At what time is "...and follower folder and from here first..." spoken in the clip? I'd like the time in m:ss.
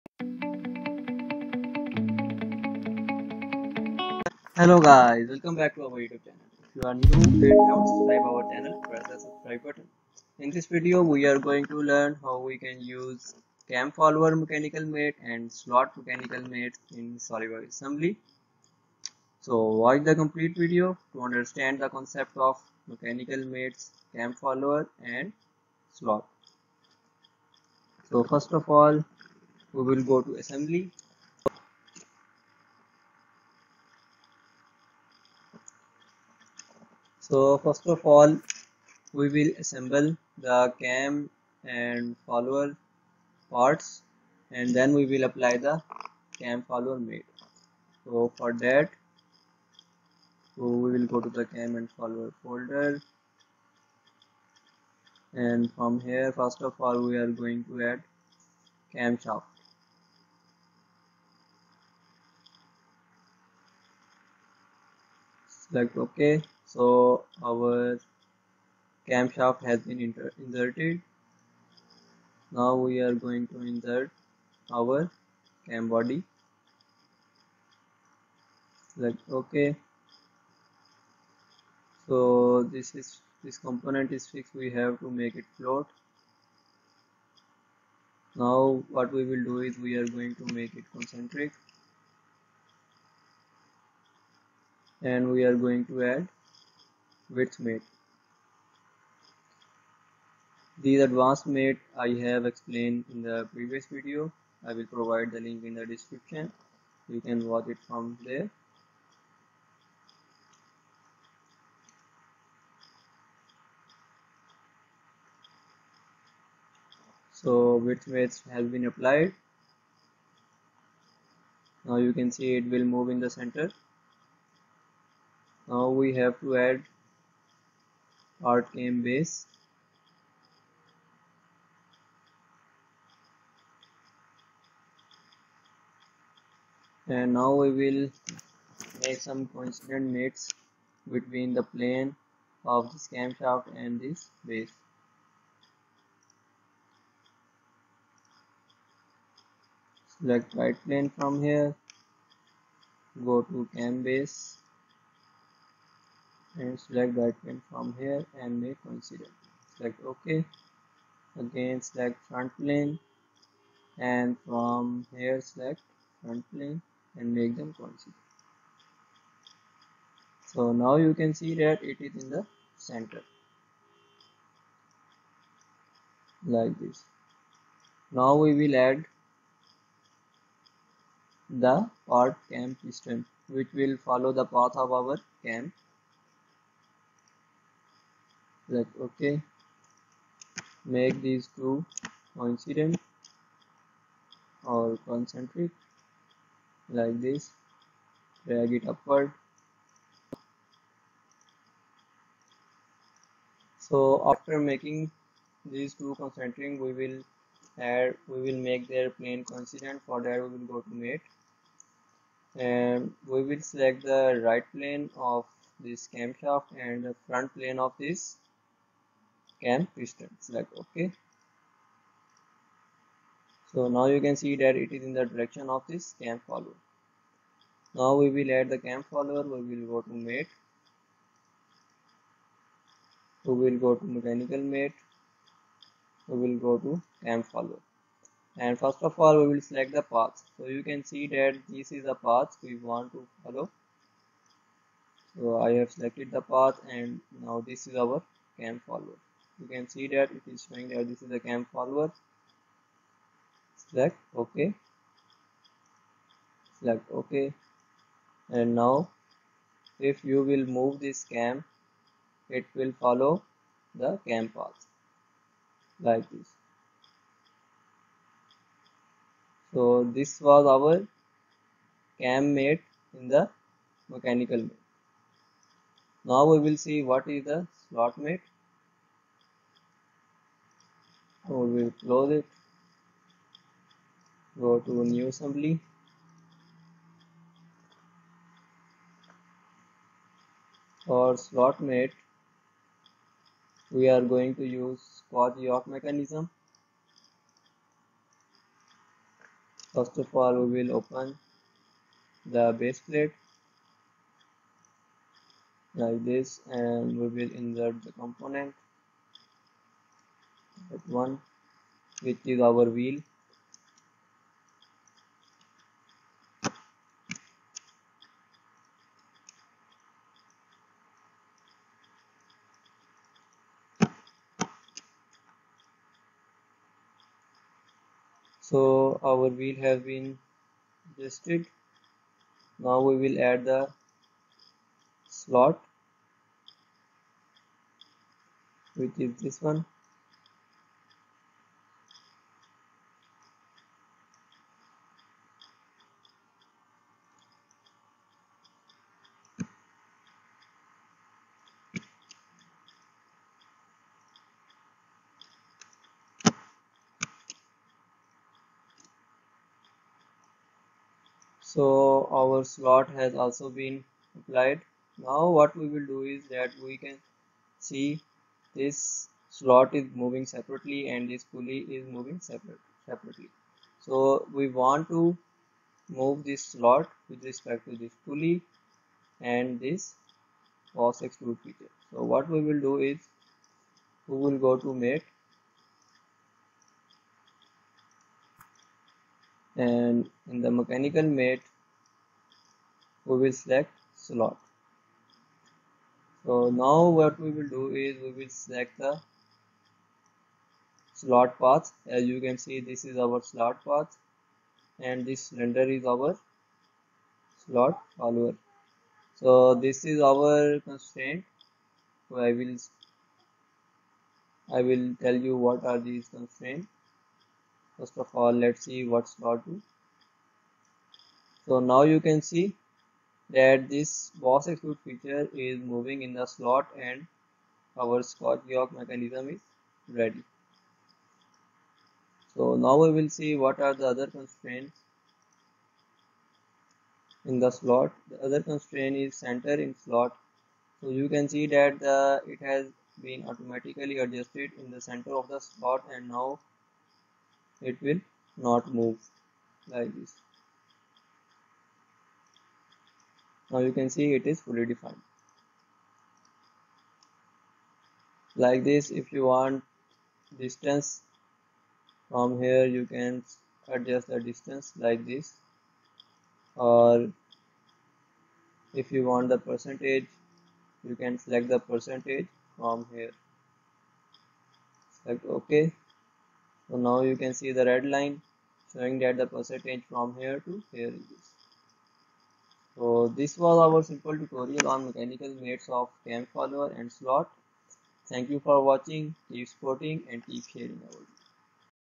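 0:51.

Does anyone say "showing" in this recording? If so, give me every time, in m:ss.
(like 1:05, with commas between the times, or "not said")
4:10, 7:58.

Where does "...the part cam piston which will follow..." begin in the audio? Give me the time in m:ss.
3:01.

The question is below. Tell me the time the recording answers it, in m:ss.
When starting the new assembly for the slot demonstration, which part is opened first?
5:02.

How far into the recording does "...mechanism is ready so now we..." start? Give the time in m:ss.
7:08.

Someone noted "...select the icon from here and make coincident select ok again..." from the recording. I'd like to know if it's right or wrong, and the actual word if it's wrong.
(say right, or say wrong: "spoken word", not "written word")
right.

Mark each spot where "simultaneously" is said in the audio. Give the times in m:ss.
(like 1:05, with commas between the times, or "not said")
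not said.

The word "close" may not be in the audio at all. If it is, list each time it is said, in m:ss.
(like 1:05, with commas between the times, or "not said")
4:41.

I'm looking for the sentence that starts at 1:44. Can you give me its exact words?
I will provide the link in the description.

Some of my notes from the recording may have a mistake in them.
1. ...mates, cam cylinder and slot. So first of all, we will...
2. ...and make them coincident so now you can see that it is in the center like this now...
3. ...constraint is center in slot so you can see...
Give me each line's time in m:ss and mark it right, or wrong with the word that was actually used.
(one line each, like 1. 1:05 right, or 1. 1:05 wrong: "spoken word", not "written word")
1. 0:23 wrong: "follower", not "cylinder"
2. 2:47 right
3. 7:18 right.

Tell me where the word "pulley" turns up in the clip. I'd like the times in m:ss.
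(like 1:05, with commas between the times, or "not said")
6:11, 6:18.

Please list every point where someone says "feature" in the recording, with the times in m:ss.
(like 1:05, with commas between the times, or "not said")
6:21, 7:05.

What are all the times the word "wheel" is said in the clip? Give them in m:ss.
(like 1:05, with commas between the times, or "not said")
5:12, 5:29.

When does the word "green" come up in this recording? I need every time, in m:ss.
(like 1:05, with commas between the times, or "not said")
not said.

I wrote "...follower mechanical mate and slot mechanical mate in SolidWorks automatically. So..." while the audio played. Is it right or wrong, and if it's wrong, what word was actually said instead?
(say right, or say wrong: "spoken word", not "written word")
wrong: "assembly", not "automatically".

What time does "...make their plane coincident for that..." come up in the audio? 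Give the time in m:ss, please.
3:28.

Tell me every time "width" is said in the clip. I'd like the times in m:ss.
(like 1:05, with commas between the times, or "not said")
1:37, 1:57.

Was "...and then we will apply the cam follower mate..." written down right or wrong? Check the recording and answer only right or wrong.
right.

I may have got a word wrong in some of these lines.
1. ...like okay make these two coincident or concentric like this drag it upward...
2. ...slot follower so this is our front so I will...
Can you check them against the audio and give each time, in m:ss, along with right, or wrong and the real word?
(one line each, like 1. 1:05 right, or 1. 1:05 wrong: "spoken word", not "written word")
1. 3:08 right
2. 6:47 wrong: "constraint", not "front".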